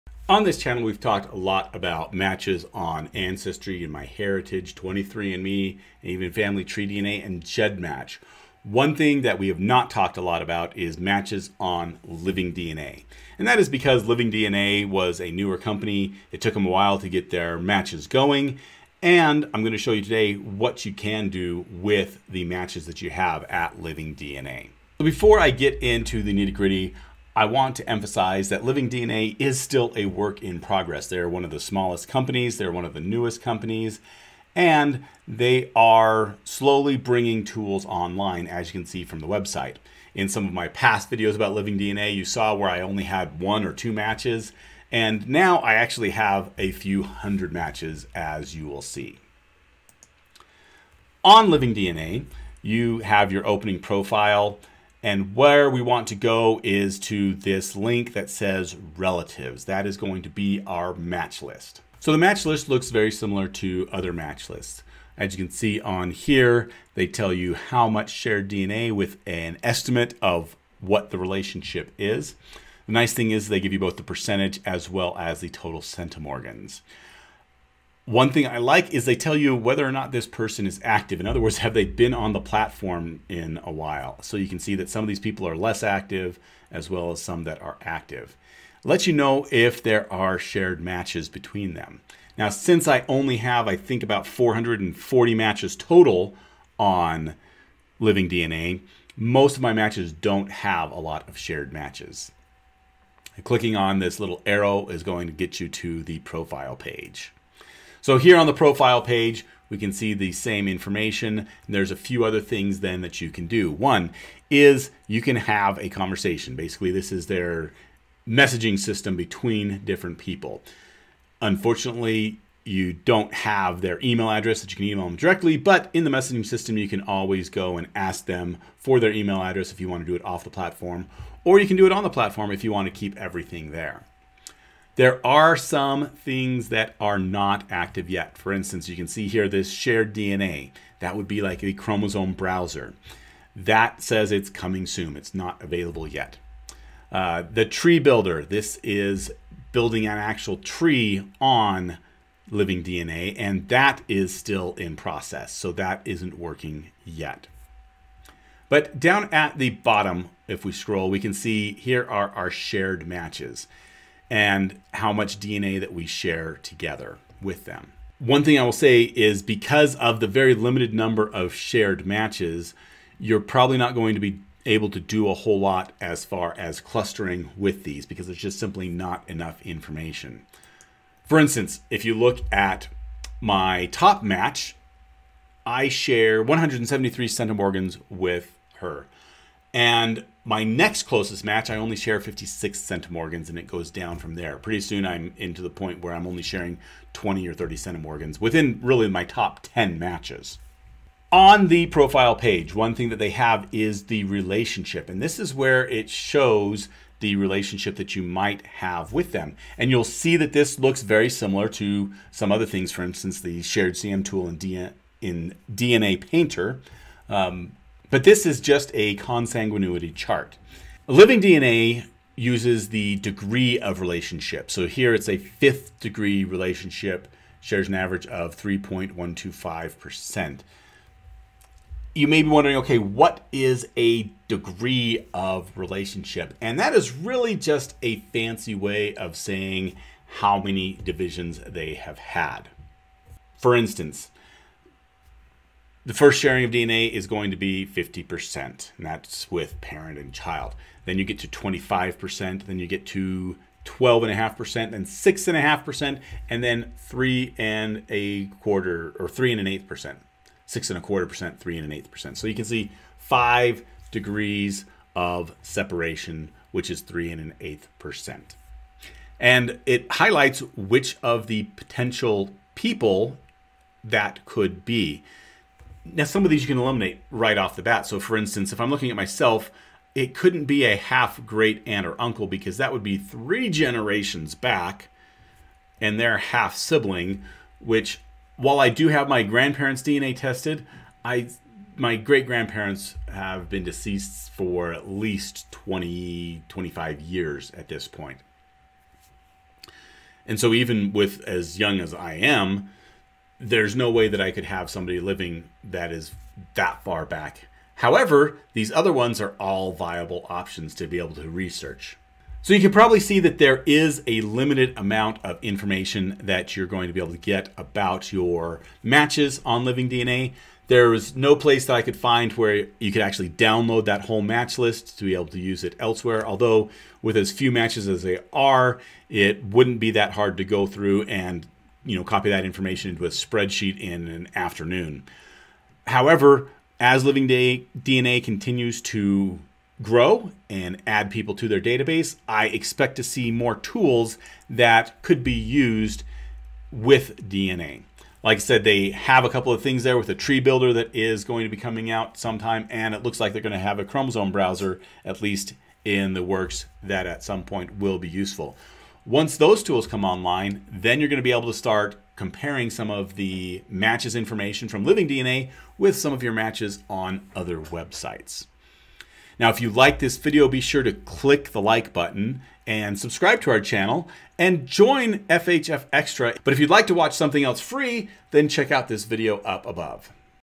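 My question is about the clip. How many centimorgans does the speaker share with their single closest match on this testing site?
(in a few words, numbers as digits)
173.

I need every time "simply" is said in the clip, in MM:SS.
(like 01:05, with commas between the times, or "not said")
02:58.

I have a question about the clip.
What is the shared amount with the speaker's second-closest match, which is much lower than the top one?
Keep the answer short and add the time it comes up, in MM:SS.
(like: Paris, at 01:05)
56 centimorgans, at 03:12.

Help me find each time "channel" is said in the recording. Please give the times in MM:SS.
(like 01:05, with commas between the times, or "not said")
00:00, 06:13.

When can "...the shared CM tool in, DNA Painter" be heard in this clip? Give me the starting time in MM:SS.
03:33.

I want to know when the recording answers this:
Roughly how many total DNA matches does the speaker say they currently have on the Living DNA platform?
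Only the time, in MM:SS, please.
01:34.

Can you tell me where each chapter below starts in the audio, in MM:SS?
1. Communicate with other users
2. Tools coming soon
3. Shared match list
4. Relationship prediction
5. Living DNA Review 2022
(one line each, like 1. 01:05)
1. 01:53
2. 02:15
3. 02:36
4. 03:20
5. 05:10.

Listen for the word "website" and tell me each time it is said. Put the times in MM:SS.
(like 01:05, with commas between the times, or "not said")
00:39, 06:07.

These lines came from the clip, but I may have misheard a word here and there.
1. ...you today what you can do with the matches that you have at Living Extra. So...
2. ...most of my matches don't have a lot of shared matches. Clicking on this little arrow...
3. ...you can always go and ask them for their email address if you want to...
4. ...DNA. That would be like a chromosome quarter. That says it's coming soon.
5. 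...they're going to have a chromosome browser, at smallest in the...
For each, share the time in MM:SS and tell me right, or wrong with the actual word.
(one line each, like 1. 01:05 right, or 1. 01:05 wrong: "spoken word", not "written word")
1. 00:19 wrong: "DNA", not "Extra"
2. 01:39 right
3. 02:06 right
4. 02:20 wrong: "browser", not "quarter"
5. 05:53 wrong: "least", not "smallest".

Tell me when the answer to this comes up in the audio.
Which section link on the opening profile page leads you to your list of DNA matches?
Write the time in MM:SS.
00:58.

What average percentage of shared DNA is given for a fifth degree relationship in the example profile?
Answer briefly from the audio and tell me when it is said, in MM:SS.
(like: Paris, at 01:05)
3.125%, at 03:48.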